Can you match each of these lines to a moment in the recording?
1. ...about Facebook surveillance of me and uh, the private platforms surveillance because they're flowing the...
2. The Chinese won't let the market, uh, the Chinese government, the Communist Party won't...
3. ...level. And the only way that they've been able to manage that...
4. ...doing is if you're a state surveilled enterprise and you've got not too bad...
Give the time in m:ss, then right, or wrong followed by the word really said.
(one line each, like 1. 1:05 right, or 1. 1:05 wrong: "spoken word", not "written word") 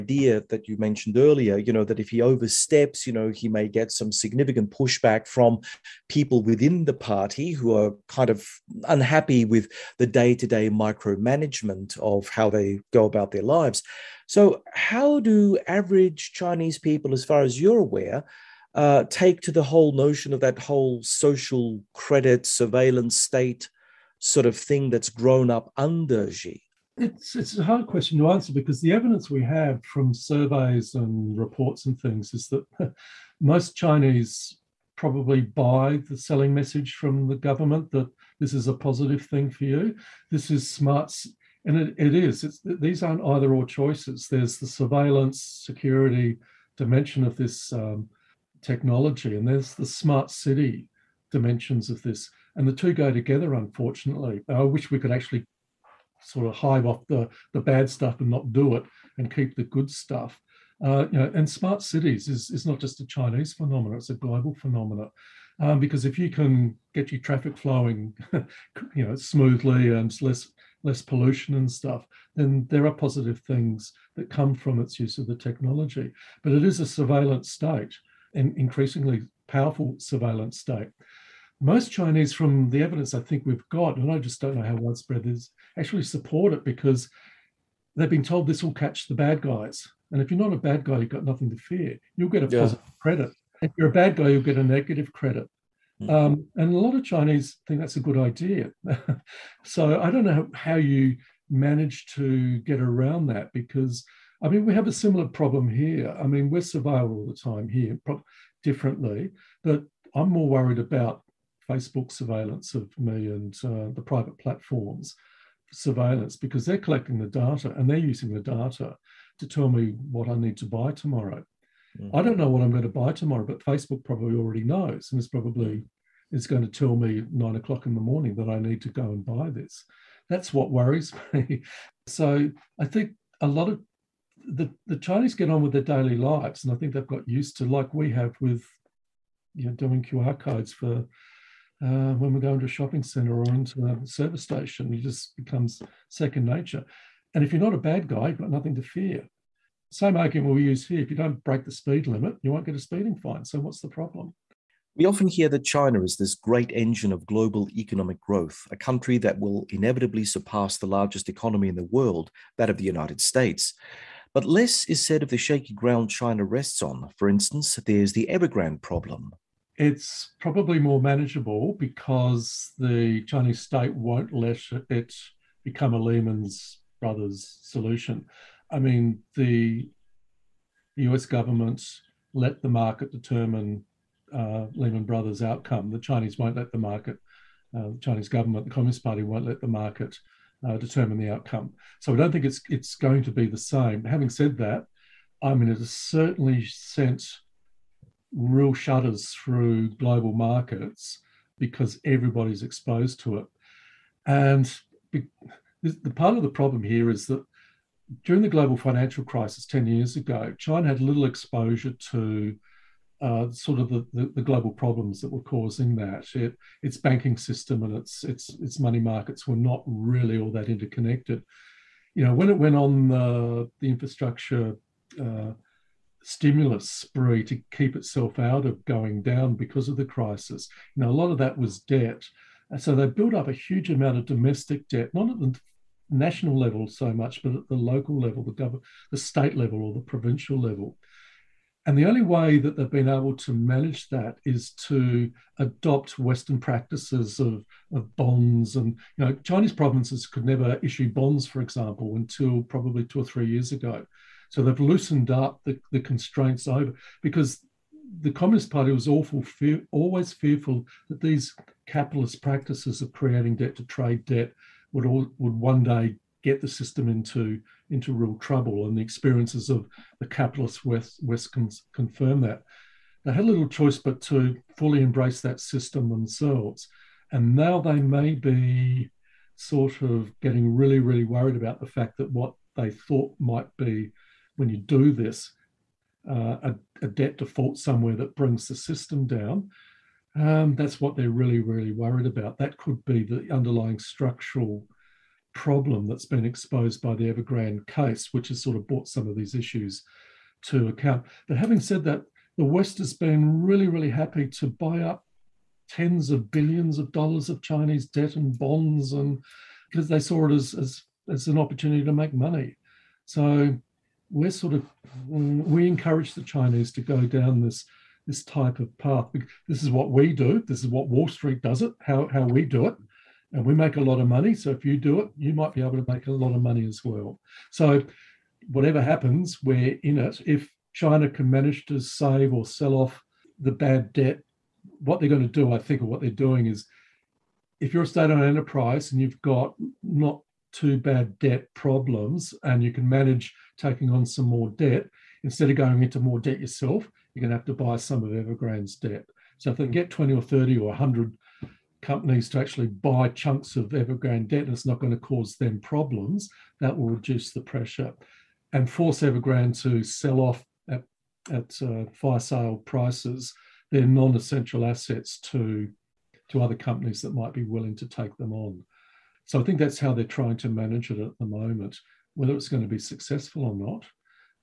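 1. 1:50 wrong: "collecting", not "flowing"
2. 3:05 right
3. 4:00 right
4. 5:36 wrong: "owned", not "surveilled".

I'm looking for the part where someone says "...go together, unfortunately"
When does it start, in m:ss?
0:52.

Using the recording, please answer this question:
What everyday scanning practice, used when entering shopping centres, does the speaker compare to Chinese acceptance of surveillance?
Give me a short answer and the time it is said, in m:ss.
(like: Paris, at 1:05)
QR codes, at 2:20.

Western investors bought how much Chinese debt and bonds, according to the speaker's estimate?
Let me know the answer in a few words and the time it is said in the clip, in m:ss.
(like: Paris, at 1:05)
tens of billions of dollars, at 5:05.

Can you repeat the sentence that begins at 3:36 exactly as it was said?
It, its banking system and its, its, its money markets were not really all that interconnected.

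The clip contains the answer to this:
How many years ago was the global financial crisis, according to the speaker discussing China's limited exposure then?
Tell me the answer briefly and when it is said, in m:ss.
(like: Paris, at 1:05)
10 years, at 3:29.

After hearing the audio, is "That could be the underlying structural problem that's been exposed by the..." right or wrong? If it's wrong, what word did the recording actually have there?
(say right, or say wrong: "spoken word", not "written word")
right.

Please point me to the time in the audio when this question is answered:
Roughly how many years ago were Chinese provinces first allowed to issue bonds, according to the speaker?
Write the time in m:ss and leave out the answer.
4:13.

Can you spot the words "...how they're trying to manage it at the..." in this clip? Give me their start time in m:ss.
6:09.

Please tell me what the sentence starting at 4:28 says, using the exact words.
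And the experiences of the capitalist West West confirm that.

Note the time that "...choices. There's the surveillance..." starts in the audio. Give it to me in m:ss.
0:43.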